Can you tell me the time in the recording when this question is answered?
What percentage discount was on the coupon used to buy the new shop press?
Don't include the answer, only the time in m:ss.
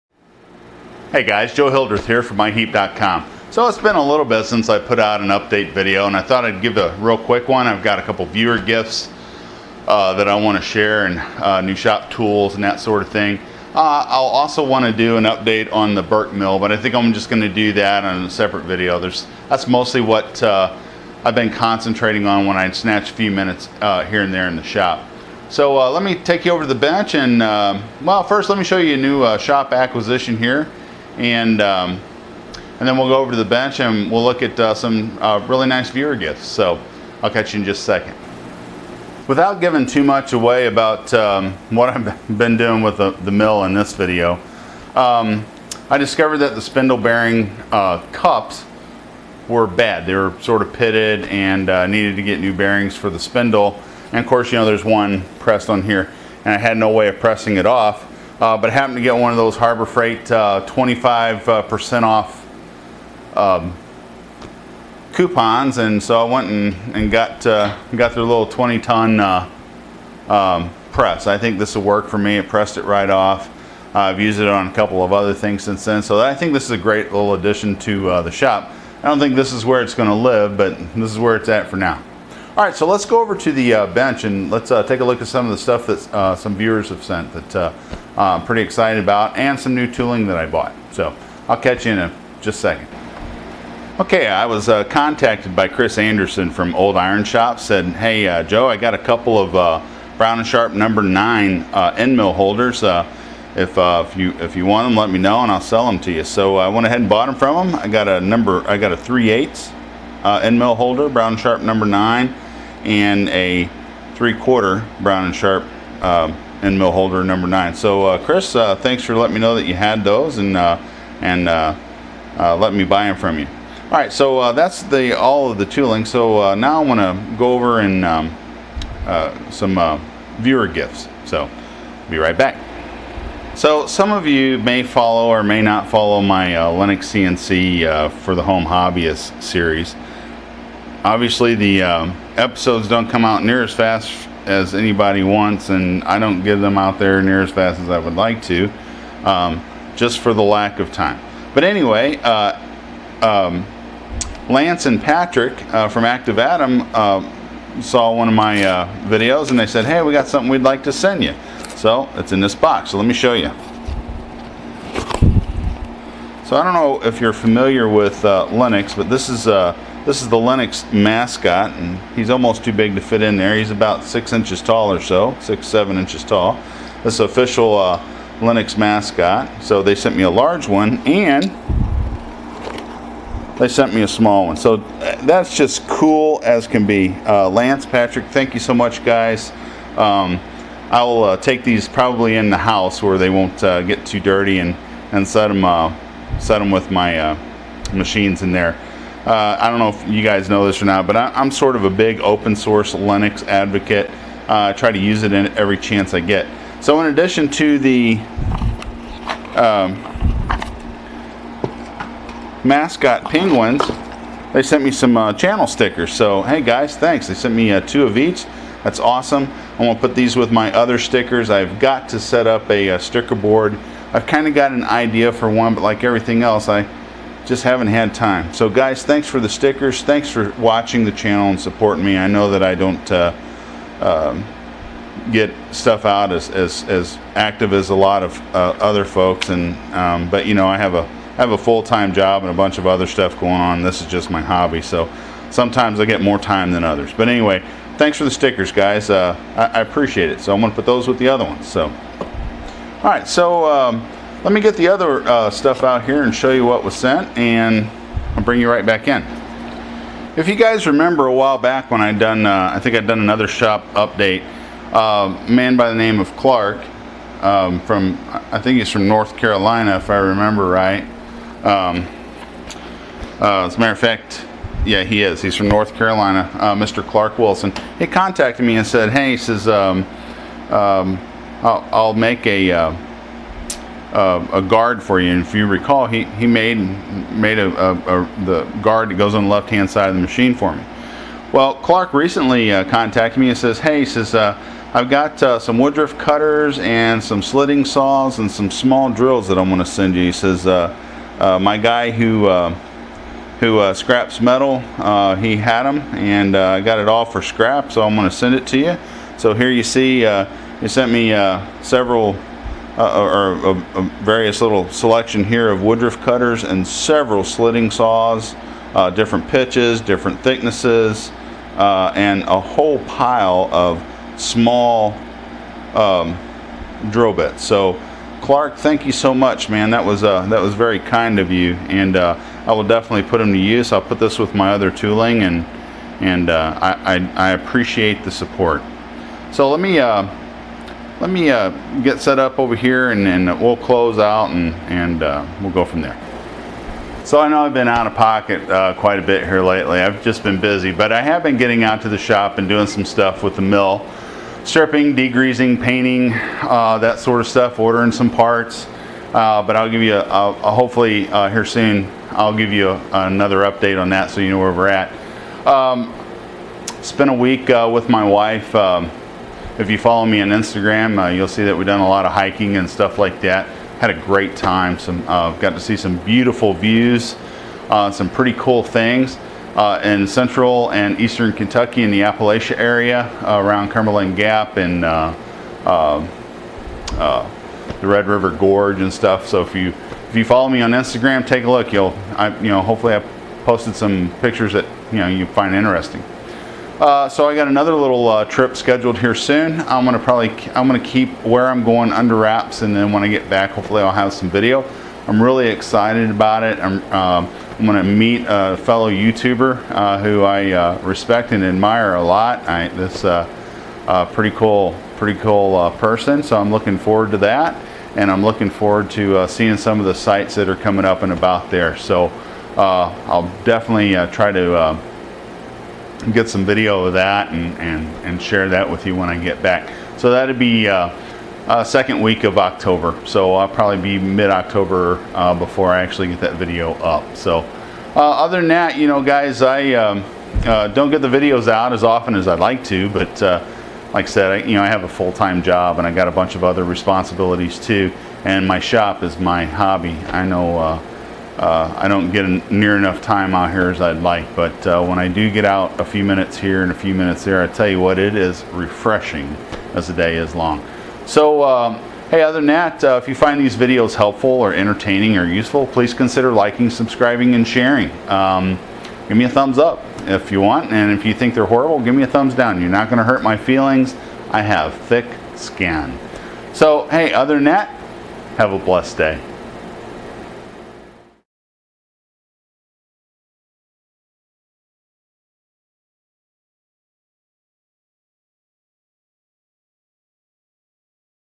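1:00.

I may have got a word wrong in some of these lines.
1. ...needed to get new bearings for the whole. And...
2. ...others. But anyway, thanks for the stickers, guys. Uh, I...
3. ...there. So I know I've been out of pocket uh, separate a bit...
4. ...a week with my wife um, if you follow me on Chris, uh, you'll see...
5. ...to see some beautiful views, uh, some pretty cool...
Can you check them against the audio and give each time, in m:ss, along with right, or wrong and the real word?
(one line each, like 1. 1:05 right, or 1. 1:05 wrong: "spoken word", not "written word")
1. 0:51 wrong: "spindle", not "whole"
2. 4:06 right
3. 5:46 wrong: "quite", not "separate"
4. 6:07 wrong: "Instagram", not "Chris"
5. 6:15 right.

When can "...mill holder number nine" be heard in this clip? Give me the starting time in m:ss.
1:56.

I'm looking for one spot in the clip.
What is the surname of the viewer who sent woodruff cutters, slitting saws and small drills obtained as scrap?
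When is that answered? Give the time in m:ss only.
4:37.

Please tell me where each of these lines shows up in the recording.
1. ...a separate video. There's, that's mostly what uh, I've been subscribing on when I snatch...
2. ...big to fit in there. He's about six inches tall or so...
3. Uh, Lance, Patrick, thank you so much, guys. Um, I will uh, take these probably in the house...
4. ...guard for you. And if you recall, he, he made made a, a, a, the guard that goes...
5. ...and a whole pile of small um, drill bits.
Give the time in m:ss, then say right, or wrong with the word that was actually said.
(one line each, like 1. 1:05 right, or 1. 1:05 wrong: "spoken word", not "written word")
1. 0:18 wrong: "concentrating", not "subscribing"
2. 2:52 right
3. 3:07 right
4. 4:44 right
5. 5:22 right.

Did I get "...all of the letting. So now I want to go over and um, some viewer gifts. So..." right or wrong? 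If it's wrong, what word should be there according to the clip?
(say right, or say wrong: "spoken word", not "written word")
wrong: "tooling", not "letting".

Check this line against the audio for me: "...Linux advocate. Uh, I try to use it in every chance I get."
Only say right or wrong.
right.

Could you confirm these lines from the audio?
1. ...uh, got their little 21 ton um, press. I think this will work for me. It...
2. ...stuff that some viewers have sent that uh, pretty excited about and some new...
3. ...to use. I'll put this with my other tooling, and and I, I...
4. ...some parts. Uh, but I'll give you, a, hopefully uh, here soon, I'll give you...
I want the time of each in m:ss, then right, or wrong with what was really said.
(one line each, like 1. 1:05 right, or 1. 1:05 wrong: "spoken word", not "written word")
1. 1:07 wrong: "20", not "21"
2. 1:25 right
3. 5:33 right
4. 5:58 right.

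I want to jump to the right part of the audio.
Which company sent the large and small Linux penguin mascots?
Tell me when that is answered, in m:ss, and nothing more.
2:36.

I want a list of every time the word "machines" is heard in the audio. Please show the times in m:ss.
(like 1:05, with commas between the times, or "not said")
3:17, 4:50.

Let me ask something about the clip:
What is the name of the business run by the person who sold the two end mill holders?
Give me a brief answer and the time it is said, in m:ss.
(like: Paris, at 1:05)
Old Iron Shop, at 1:36.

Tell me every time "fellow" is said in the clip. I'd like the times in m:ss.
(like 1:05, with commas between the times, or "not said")
6:48.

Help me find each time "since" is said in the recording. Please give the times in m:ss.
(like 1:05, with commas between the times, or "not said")
0:04, 1:15.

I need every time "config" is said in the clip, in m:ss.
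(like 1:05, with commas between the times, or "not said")
not said.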